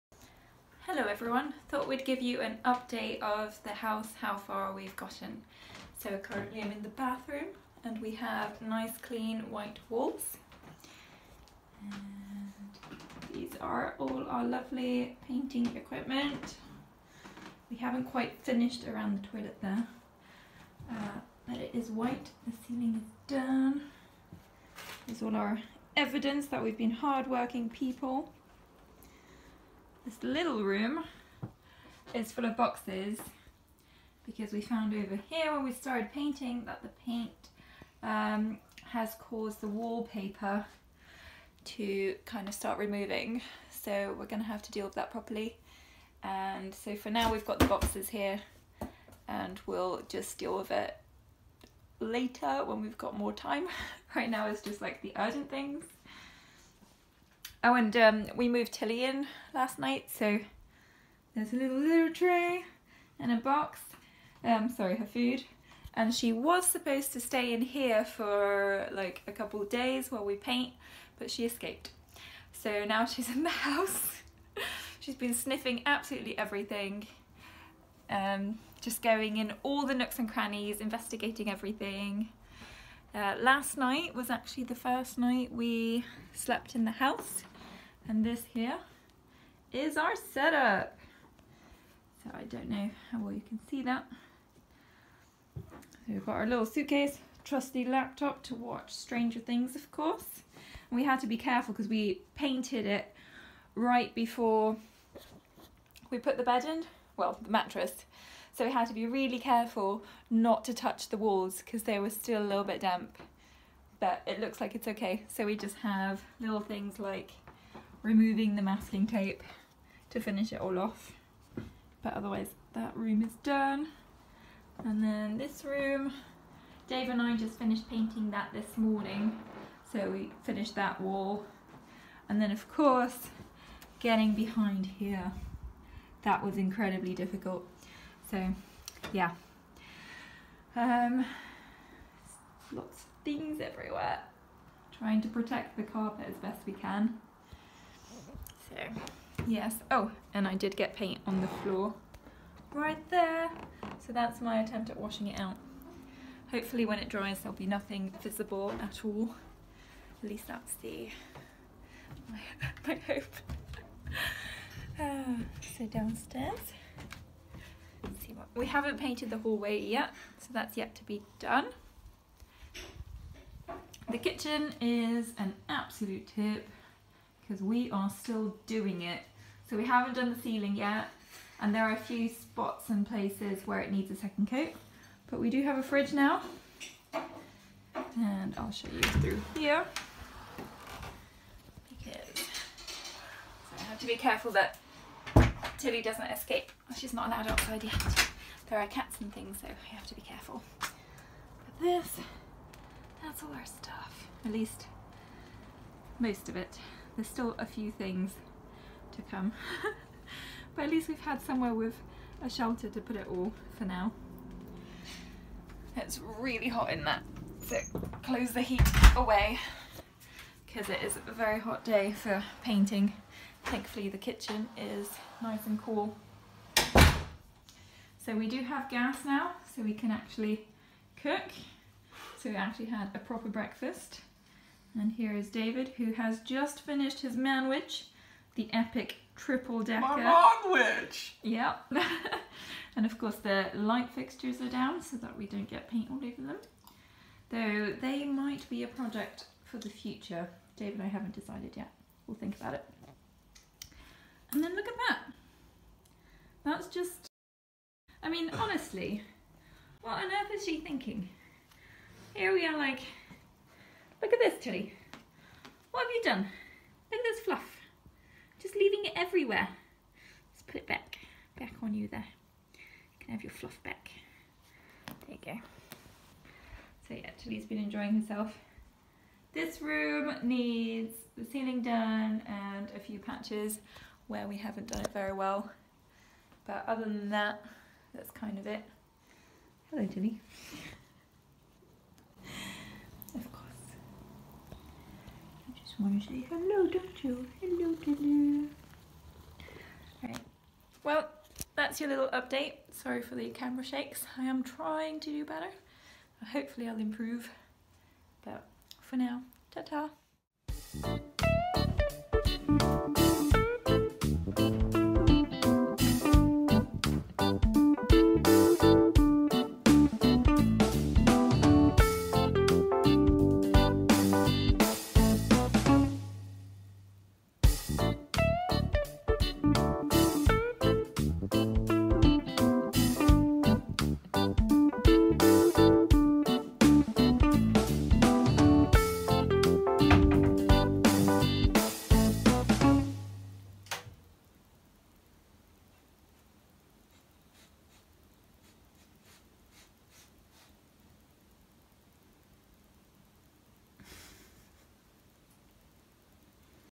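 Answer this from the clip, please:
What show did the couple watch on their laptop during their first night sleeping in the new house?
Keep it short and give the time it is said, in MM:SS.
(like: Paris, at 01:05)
Stranger Things, at 01:38.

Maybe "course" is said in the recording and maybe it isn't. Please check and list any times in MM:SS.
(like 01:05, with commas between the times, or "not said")
01:39, 02:12, 04:03.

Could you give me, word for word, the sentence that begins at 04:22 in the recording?
Here we are like Look at this, Tilly.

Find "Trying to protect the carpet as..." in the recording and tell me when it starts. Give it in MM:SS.
02:24.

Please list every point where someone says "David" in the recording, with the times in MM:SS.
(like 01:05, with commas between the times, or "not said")
03:55, 04:10.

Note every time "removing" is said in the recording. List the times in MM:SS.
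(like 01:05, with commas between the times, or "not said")
00:42, 01:58.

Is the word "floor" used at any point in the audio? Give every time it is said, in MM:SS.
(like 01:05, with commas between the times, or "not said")
02:31.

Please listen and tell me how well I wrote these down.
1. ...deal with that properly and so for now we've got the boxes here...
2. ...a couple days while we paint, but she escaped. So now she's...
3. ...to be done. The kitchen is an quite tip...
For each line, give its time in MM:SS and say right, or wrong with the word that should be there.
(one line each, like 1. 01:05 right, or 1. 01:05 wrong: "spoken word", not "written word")
1. 00:44 right
2. 01:09 right
3. 02:50 wrong: "absolute", not "quite".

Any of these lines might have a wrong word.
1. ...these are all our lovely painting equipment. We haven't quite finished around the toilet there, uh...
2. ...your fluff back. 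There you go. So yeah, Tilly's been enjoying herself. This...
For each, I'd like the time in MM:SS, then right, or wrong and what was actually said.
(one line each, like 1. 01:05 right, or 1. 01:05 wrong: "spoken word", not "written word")
1. 00:13 right
2. 04:33 right.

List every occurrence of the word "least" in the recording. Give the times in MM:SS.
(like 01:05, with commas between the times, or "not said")
02:40, 03:24, 03:30.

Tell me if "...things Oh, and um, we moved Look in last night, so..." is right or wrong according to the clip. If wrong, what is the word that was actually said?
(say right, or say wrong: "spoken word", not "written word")
wrong: "Tilly", not "Look".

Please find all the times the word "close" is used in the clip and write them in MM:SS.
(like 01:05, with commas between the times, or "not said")
03:38.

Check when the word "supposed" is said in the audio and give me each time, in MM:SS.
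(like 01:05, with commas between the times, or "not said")
01:06.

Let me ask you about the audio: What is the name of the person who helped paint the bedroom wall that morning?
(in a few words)
Dave.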